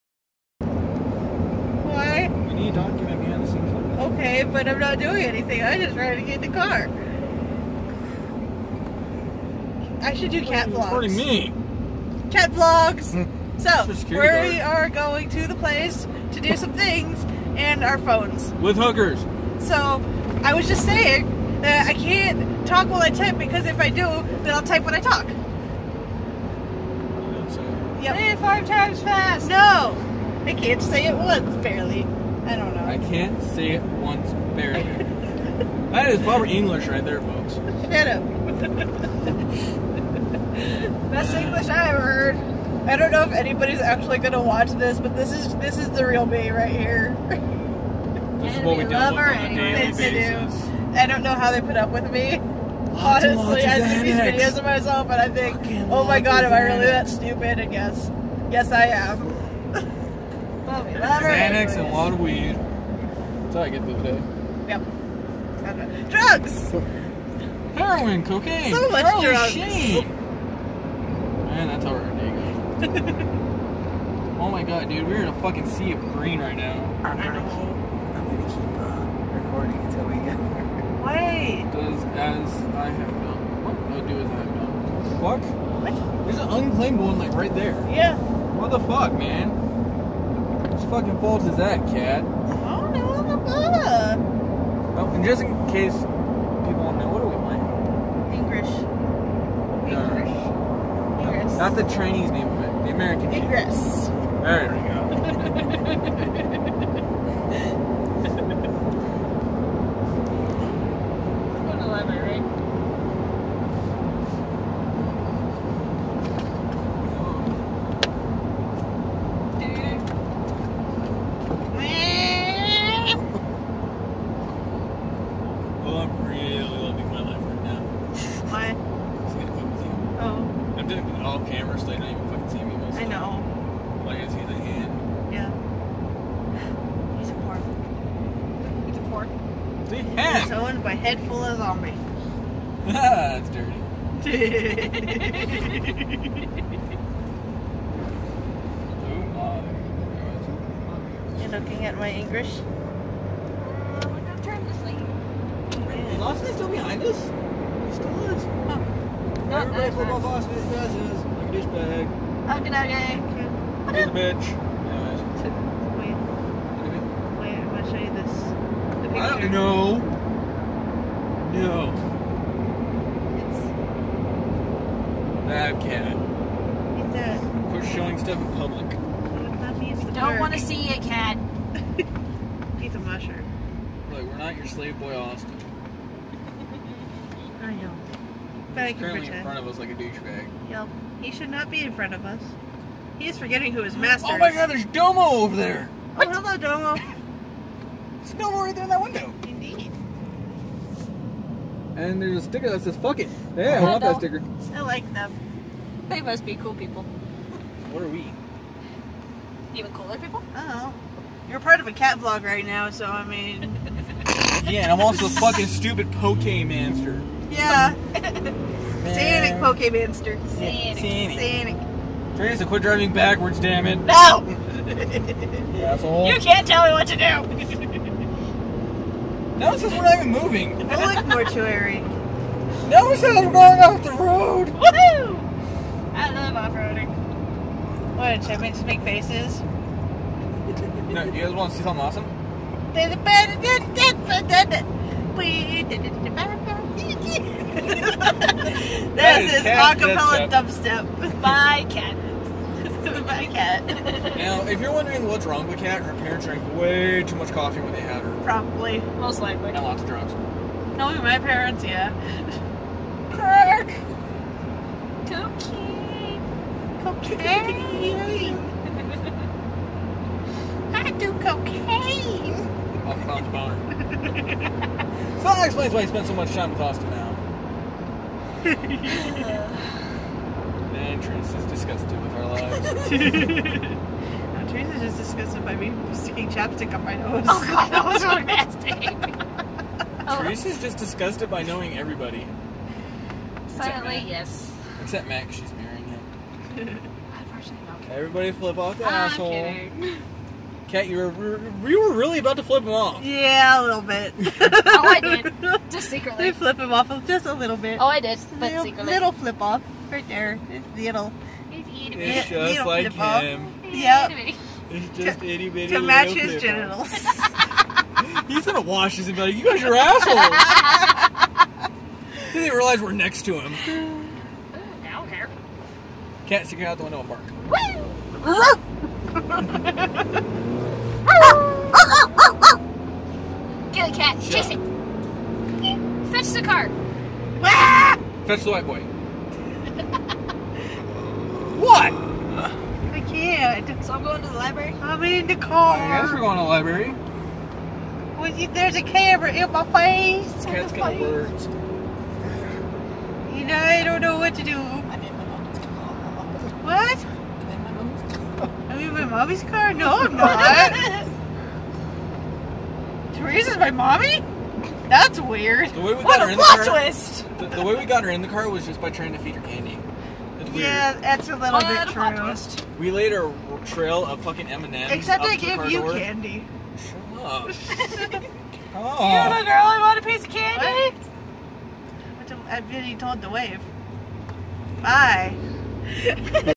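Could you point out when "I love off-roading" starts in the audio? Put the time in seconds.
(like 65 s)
236 s.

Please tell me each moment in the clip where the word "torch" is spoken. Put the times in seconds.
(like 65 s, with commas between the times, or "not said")
not said.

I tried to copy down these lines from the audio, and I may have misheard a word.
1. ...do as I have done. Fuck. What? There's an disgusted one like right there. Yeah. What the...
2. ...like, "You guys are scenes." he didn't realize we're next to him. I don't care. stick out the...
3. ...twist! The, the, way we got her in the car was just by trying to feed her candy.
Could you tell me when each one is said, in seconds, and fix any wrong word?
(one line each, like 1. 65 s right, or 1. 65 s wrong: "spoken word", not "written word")
1. 84 s wrong: "unclaimed", not "disgusted"
2. 319 s wrong: "assholes", not "scenes"
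3. 366 s right.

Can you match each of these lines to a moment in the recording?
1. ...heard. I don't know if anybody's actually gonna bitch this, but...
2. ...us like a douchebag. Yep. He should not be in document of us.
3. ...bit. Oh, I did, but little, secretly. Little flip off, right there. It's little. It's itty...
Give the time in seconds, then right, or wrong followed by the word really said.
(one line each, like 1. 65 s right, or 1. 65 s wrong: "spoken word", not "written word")
1. 42 s wrong: "watch", not "bitch"
2. 189 s wrong: "front", not "document"
3. 307 s right.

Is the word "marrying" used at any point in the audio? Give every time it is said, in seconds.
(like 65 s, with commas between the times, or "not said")
295 s.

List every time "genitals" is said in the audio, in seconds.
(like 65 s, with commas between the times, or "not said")
316 s.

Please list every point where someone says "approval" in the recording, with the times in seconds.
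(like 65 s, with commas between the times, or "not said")
not said.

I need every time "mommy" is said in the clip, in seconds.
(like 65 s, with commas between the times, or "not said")
359 s, 363 s.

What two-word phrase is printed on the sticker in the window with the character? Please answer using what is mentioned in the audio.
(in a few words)
fuck it.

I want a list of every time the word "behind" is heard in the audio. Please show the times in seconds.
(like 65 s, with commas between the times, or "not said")
3 s, 156 s.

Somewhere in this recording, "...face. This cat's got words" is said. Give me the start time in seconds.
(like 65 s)
349 s.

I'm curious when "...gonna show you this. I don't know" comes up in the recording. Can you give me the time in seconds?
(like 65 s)
167 s.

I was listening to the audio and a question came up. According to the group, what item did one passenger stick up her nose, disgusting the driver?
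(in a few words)
chapstick.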